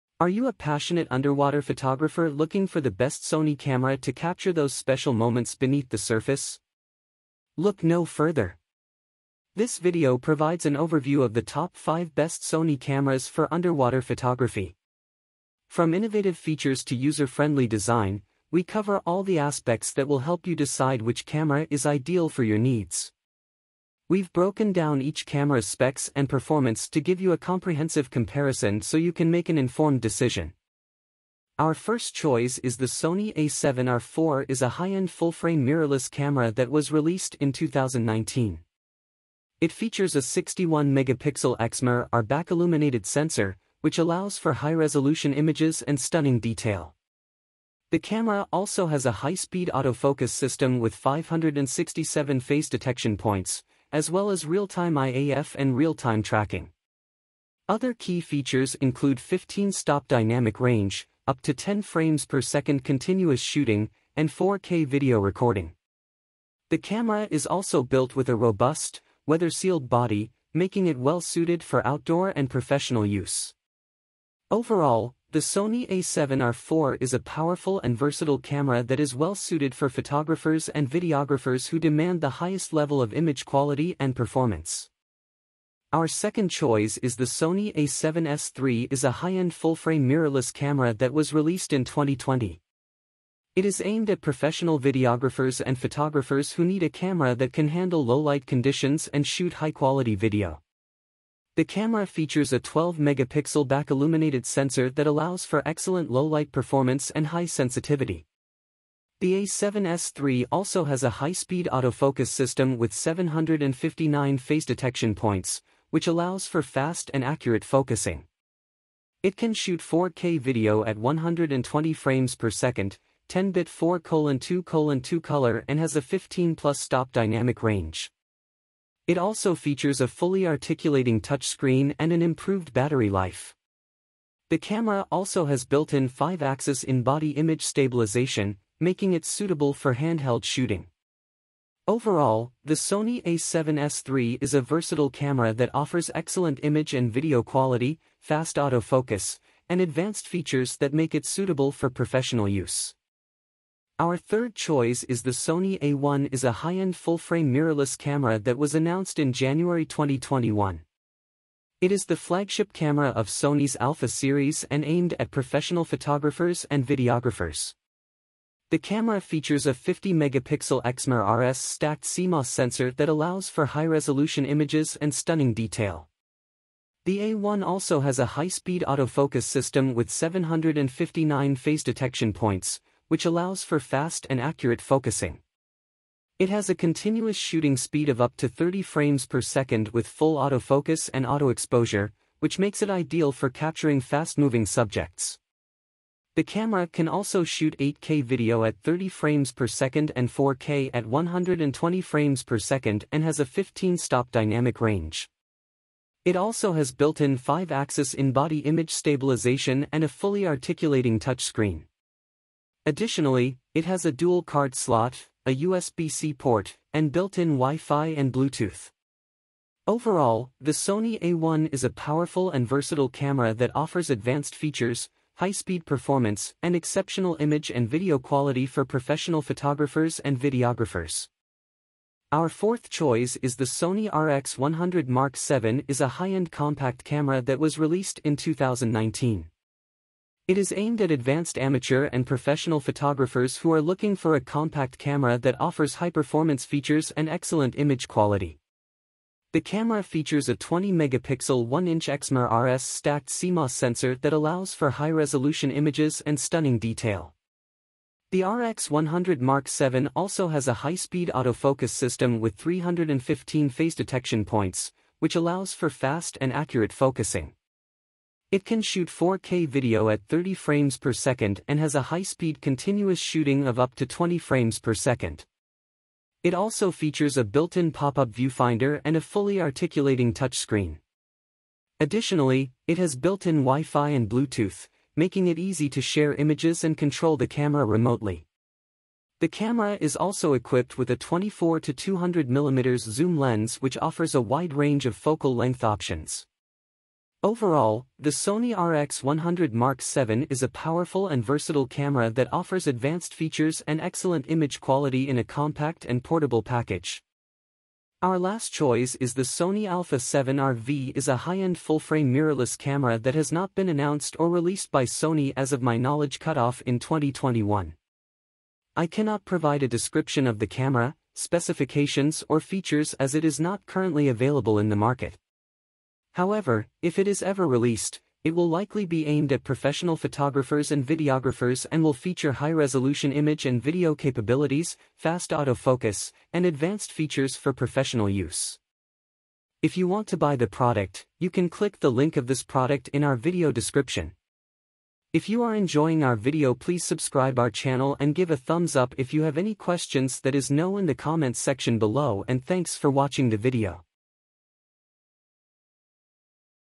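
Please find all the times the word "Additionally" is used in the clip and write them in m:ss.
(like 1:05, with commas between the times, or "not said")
3:32, 4:42.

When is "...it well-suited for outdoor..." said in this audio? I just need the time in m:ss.
1:10.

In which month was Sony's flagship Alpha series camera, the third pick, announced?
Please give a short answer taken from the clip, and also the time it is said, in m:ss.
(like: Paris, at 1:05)
January, at 2:39.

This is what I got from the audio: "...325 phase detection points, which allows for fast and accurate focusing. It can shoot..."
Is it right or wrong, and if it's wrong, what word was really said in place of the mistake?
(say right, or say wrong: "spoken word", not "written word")
wrong: "315", not "325".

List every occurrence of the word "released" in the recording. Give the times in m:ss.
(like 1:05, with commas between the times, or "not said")
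0:36, 1:31, 3:57, 5:14, 5:27.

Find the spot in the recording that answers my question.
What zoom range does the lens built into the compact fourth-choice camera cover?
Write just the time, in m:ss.
4:51.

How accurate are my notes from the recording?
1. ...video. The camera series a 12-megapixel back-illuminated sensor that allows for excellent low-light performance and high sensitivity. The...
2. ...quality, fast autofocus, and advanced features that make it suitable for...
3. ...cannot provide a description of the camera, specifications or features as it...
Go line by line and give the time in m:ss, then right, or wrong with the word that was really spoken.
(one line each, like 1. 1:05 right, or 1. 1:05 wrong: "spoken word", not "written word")
1. 1:40 wrong: "features", not "series"
2. 2:27 right
3. 5:19 right.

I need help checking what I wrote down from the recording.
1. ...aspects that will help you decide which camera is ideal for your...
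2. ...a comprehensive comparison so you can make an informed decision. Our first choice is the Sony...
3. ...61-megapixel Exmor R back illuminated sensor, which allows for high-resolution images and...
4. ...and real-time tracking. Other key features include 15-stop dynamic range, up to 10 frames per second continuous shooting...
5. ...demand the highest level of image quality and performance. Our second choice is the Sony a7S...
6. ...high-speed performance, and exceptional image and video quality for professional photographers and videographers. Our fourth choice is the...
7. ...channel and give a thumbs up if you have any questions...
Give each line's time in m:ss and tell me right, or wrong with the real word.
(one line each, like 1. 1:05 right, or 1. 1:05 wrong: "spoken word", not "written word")
1. 0:19 right
2. 0:27 right
3. 0:40 right
4. 0:55 right
5. 1:21 right
6. 3:45 right
7. 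5:47 right.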